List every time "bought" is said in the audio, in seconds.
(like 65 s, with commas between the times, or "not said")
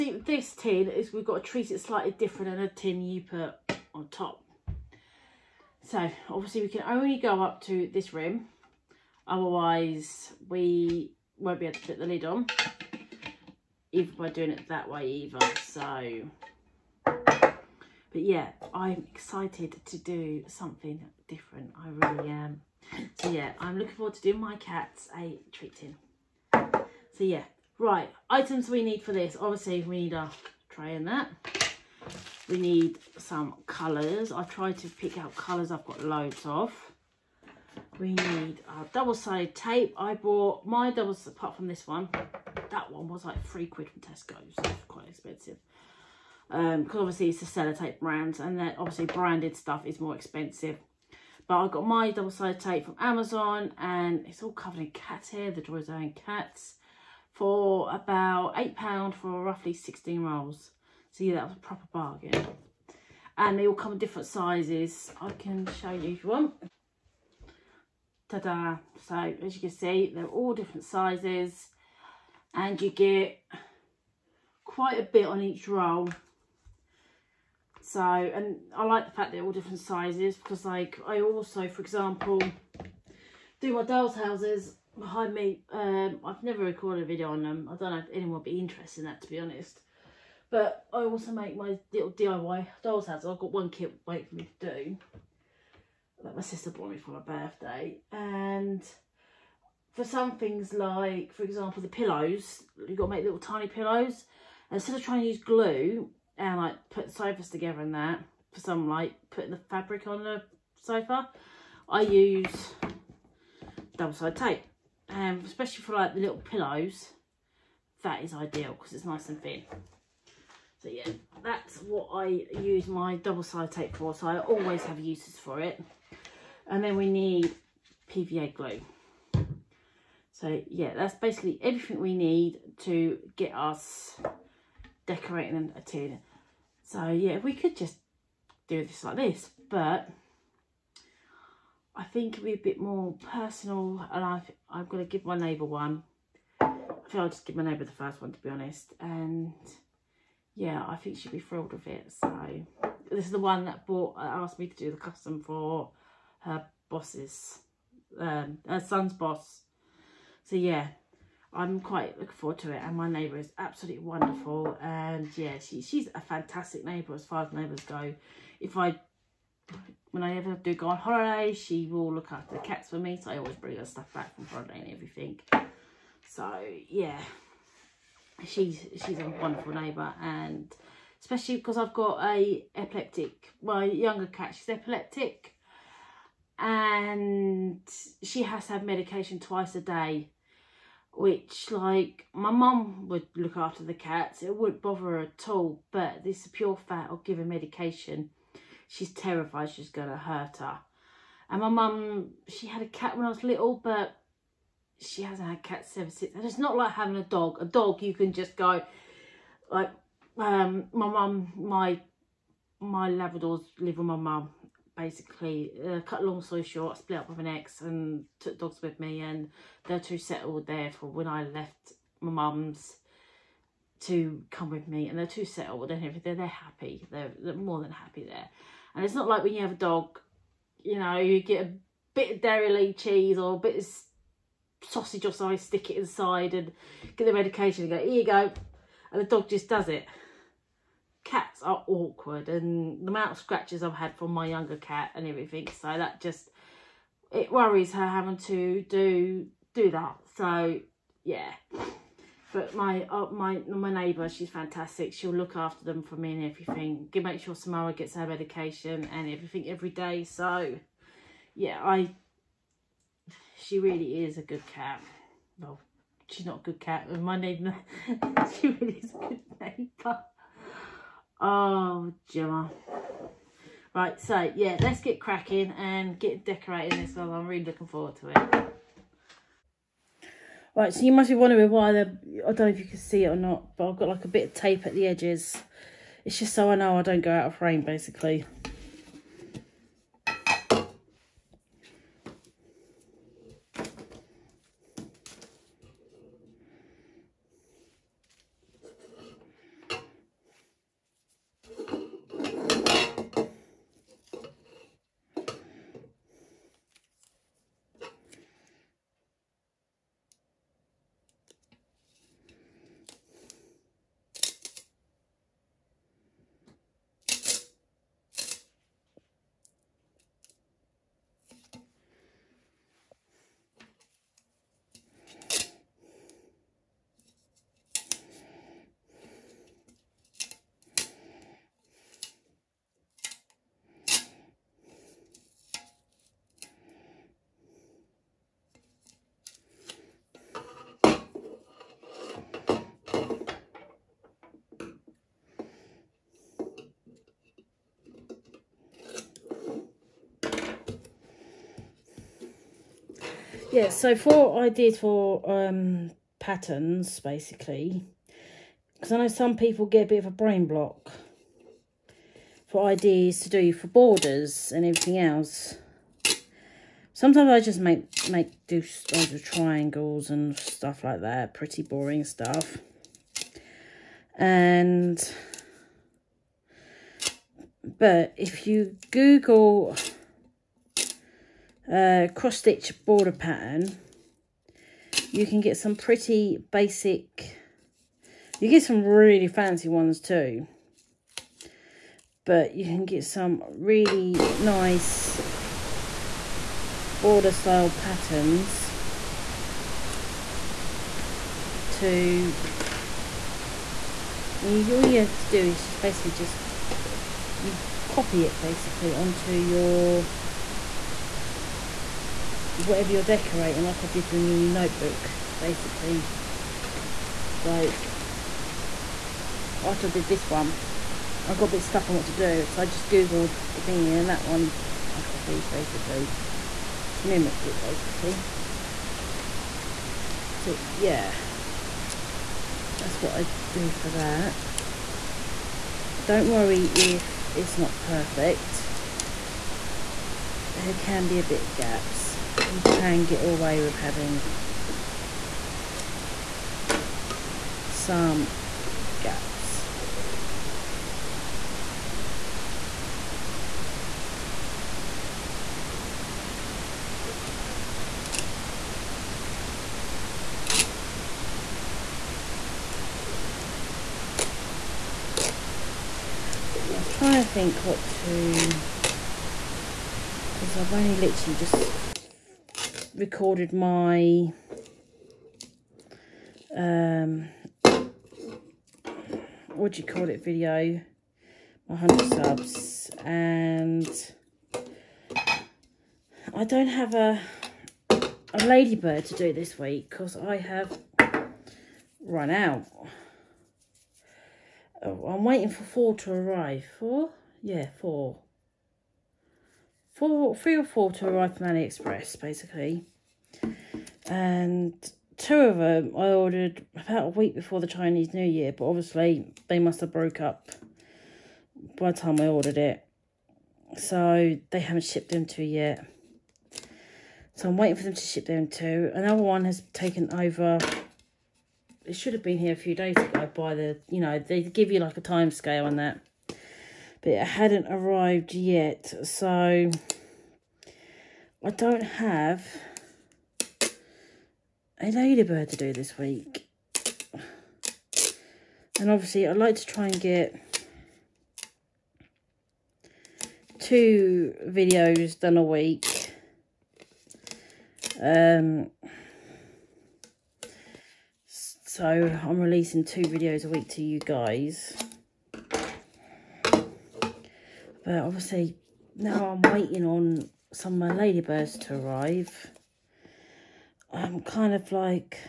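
40 s, 96 s, 153 s.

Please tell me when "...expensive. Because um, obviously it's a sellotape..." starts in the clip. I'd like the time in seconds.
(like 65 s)
45 s.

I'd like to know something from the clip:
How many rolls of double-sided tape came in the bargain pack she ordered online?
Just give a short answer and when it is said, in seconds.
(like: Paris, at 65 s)
16, at 59 s.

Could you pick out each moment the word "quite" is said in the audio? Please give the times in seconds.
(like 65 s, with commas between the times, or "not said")
44 s, 74 s, 161 s.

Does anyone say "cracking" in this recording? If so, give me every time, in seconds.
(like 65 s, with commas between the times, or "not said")
275 s.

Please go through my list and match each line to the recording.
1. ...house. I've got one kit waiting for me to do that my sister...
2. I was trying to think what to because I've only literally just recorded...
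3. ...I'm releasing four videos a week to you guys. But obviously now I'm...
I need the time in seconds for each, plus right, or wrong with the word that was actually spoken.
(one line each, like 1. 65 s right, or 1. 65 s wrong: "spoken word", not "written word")
1. 93 s right
2. 466 s right
3. 552 s wrong: "two", not "four".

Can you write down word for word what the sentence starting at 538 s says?
And obviously I like to try and get two videos done a week.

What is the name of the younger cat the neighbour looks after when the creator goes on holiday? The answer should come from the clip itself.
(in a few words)
Samara.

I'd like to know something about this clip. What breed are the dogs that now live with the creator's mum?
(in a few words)
Labradors.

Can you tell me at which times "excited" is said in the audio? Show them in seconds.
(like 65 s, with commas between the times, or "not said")
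19 s.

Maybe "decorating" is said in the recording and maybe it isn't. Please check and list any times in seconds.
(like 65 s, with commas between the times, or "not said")
135 s, 276 s, 413 s.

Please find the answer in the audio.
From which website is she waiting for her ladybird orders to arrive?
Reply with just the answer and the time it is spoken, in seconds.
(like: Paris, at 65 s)
AliExpress, at 501 s.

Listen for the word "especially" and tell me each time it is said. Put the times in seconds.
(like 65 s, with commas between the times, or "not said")
115 s, 181 s.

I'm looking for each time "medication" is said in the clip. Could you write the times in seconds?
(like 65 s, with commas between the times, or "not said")
188 s, 197 s, 237 s, 258 s.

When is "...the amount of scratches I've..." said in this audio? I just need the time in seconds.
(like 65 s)
243 s.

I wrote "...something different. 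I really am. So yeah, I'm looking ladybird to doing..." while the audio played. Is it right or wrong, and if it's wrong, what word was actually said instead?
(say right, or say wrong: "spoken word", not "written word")
wrong: "forward", not "ladybird".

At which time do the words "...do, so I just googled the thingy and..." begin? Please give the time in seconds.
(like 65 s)
422 s.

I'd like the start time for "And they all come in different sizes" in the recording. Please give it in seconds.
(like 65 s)
63 s.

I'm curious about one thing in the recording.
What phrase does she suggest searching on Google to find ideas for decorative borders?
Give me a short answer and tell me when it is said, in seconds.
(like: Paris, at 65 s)
cross stitch border pattern, at 382 s.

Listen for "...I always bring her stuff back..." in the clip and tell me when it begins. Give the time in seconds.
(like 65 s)
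173 s.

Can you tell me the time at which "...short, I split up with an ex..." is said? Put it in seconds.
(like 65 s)
216 s.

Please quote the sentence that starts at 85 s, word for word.
Um, I've never recorded a video on them.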